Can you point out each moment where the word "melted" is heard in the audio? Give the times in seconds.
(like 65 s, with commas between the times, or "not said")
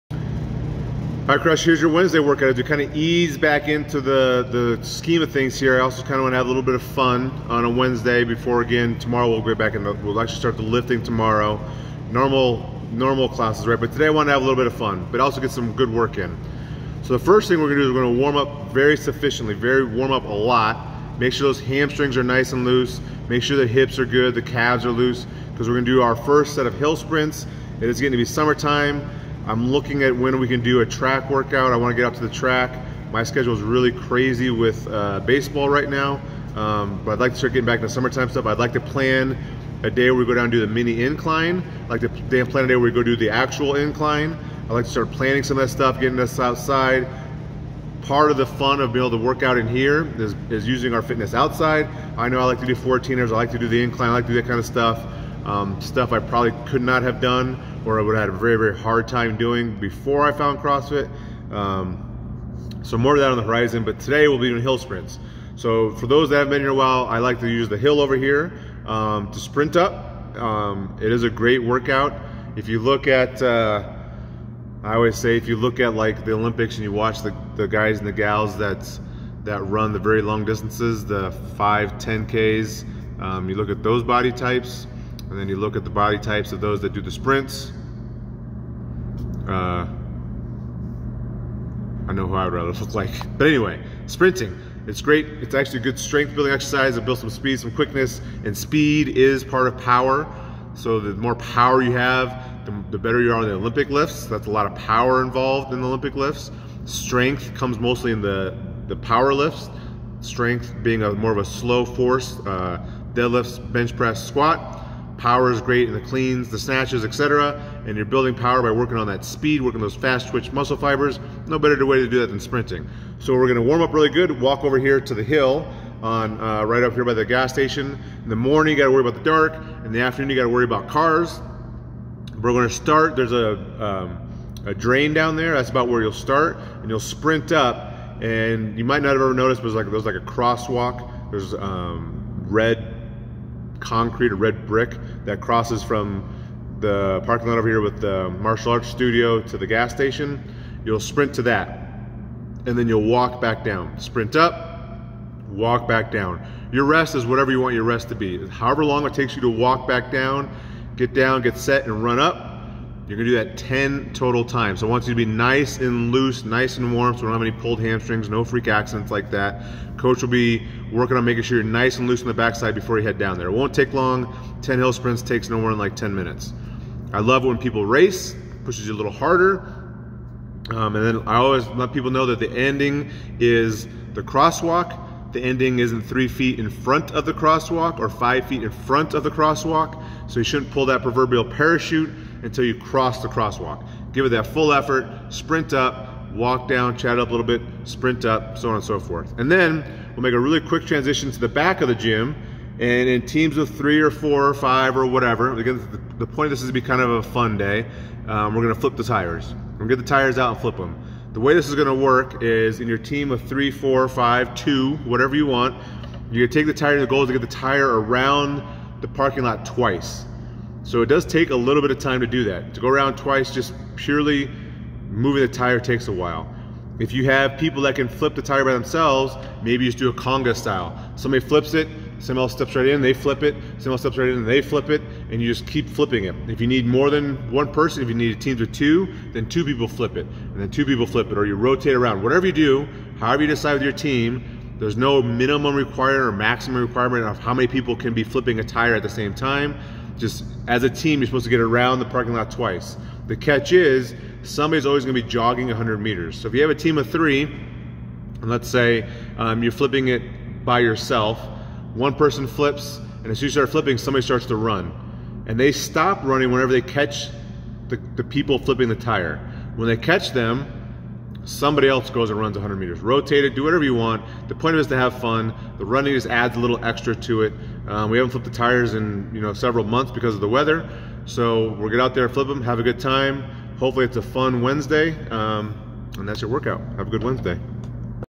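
not said.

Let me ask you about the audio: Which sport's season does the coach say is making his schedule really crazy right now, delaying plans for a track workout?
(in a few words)
Baseball.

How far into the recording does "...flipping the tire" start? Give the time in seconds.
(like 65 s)
268 s.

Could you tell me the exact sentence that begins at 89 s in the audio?
Uh, I know who I would rather look like.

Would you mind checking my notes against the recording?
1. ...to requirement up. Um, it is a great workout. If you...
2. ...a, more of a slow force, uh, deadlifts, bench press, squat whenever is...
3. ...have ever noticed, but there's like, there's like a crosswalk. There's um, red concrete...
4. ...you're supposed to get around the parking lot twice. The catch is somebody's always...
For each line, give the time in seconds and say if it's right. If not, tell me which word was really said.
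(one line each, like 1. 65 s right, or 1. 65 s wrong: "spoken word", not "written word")
1. 69 s wrong: "sprint", not "requirement"
2. 111 s wrong: "power", not "whenever"
3. 139 s right
4. 251 s right.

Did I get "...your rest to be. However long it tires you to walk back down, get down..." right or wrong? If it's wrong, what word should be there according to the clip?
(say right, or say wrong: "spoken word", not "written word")
wrong: "takes", not "tires".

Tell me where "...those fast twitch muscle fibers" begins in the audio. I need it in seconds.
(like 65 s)
119 s.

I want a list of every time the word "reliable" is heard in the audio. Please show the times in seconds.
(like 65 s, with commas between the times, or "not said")
not said.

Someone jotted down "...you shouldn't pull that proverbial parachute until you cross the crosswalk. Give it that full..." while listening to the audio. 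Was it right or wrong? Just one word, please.
right.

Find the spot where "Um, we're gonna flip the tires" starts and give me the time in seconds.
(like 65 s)
208 s.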